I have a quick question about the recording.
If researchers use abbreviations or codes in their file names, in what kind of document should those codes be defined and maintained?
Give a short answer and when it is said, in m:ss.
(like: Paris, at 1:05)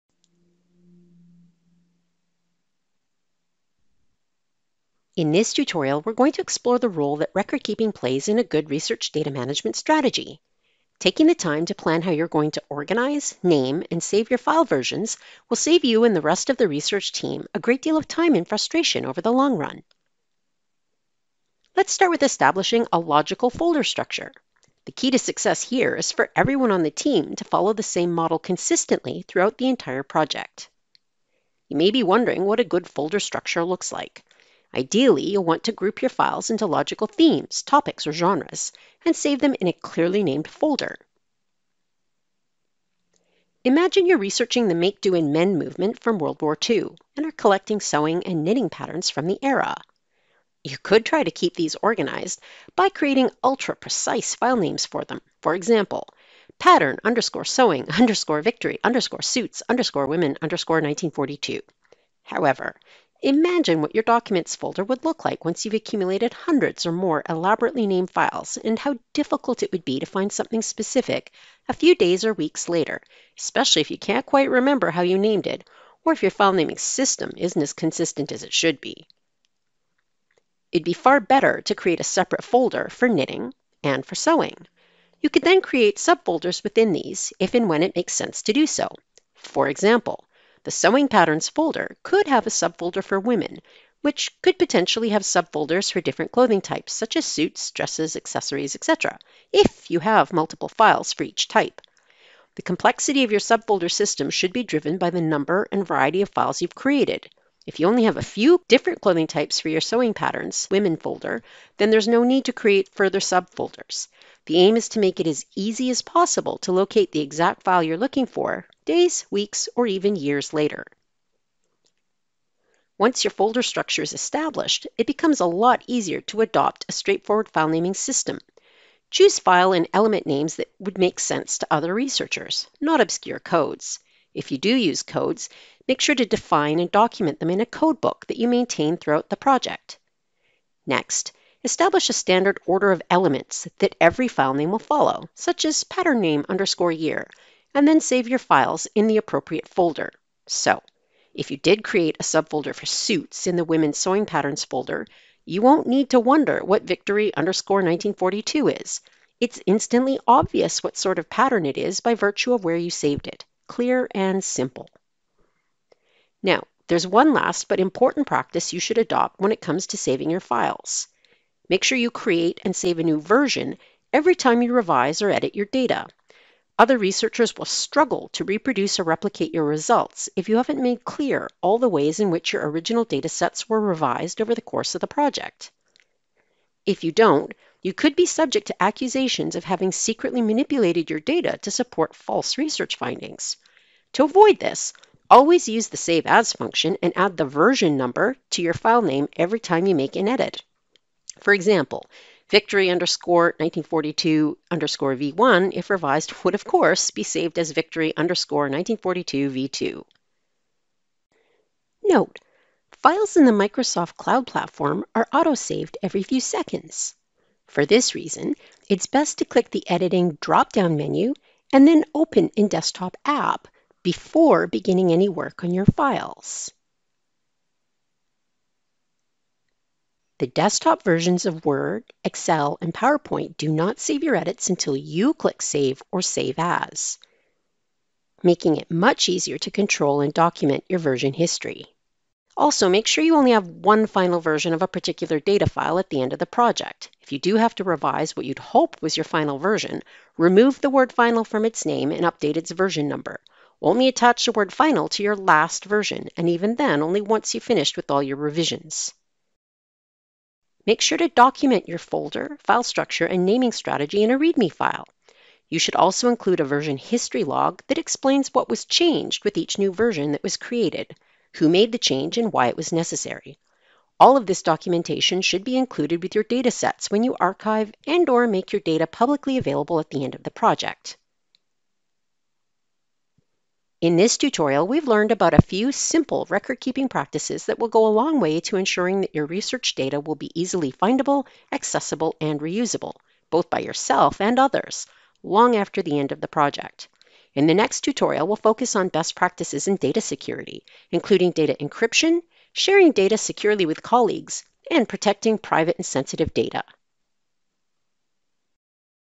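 code book, at 2:17.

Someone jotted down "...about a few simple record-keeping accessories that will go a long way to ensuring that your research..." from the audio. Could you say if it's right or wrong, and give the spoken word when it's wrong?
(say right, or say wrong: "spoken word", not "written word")
wrong: "practices", not "accessories".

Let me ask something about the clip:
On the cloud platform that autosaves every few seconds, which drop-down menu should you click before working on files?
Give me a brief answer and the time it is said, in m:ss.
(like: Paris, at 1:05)
Editing, at 3:39.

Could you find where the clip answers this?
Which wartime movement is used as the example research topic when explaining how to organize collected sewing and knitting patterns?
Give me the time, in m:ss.
0:44.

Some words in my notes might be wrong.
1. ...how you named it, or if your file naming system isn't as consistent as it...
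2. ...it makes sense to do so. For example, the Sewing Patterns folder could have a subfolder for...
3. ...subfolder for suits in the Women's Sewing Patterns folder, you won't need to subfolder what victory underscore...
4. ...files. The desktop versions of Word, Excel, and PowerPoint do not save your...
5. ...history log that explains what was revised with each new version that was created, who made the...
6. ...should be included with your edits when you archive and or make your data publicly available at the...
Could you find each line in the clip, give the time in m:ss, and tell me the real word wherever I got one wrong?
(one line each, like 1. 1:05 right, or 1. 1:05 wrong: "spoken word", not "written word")
1. 1:14 right
2. 1:27 right
3. 2:32 wrong: "wonder", not "subfolder"
4. 3:45 right
5. 4:26 wrong: "changed", not "revised"
6. 4:35 wrong: "datasets", not "edits".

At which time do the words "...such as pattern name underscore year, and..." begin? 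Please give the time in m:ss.
2:25.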